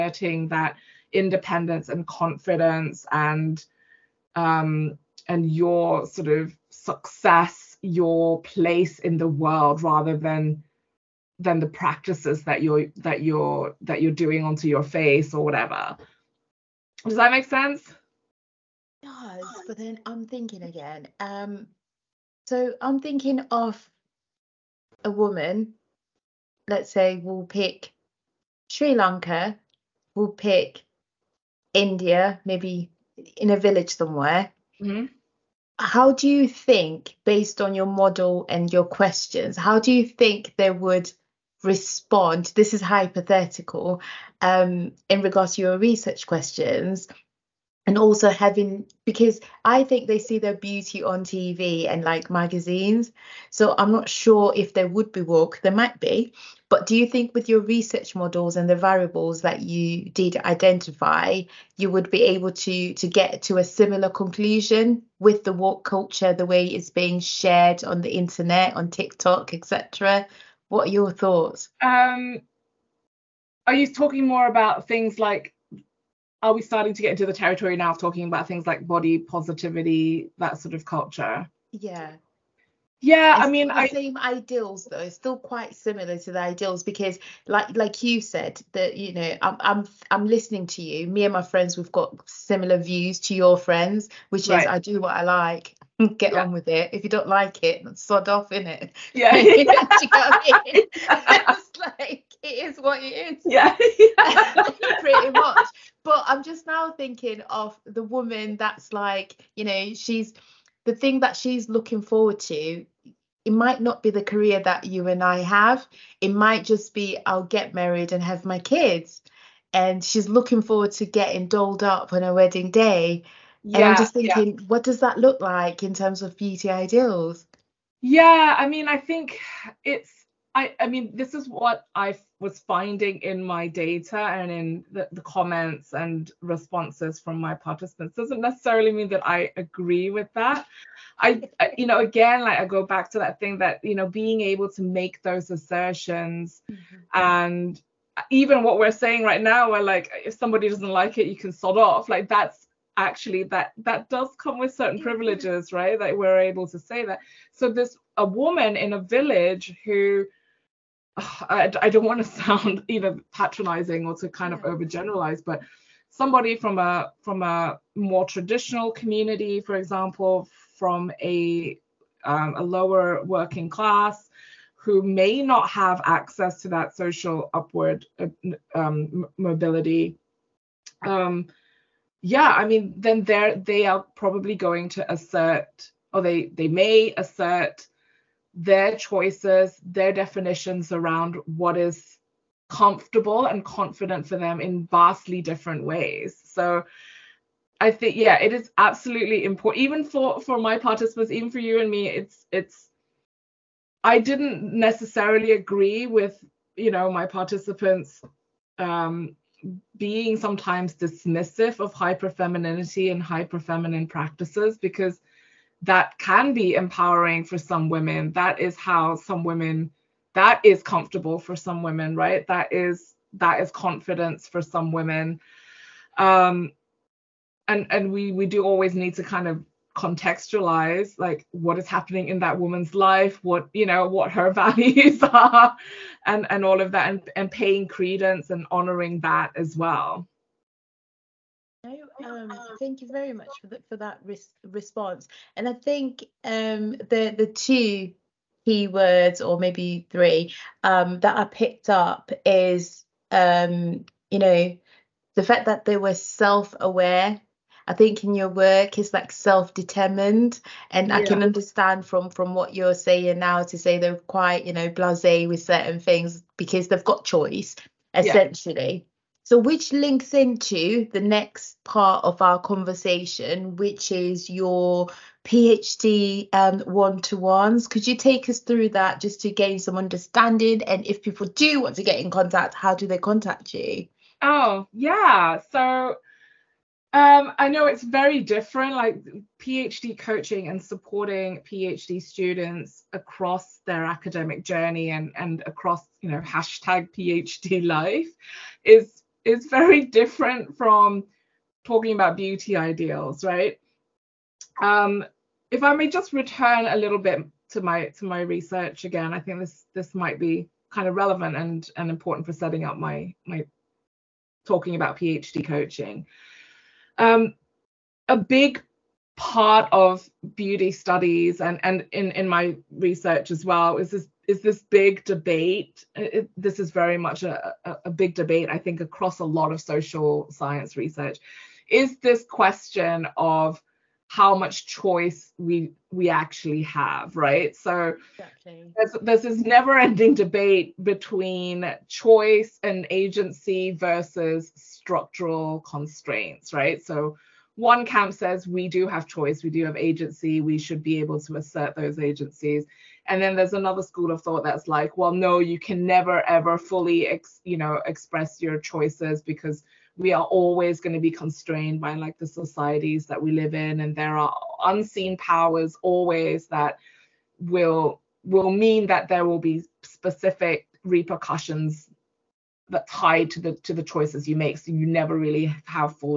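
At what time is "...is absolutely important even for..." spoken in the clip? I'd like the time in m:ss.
3:18.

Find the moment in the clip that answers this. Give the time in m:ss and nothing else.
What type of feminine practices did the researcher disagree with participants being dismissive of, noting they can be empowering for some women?
3:33.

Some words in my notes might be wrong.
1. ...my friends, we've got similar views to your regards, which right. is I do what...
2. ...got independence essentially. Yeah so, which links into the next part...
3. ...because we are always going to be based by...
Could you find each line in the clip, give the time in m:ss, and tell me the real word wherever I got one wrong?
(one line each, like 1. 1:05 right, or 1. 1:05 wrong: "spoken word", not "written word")
1. 1:31 wrong: "friends", not "regards"
2. 4:27 wrong: "choice", not "independence"
3. 5:59 wrong: "constrained", not "based".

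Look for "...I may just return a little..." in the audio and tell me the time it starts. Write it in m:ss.
5:05.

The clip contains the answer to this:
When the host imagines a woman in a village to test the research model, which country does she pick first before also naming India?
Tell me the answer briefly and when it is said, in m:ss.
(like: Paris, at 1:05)
Sri Lanka, at 0:28.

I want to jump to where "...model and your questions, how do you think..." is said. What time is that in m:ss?
0:37.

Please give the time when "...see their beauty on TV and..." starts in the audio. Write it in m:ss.
0:50.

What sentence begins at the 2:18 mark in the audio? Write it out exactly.
Doesn't necessarily mean that I agree with that.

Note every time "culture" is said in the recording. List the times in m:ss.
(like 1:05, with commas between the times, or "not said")
1:05, 1:20.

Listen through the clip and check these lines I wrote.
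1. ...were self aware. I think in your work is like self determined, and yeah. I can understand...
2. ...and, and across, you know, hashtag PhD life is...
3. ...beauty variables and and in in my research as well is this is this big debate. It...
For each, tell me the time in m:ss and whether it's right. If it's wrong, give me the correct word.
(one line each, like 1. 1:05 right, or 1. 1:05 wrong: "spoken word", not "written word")
1. 4:15 right
2. 4:55 right
3. 5:20 wrong: "studies", not "variables".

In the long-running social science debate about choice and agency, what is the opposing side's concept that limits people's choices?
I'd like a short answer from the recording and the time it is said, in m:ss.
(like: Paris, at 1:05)
structural constraints, at 5:44.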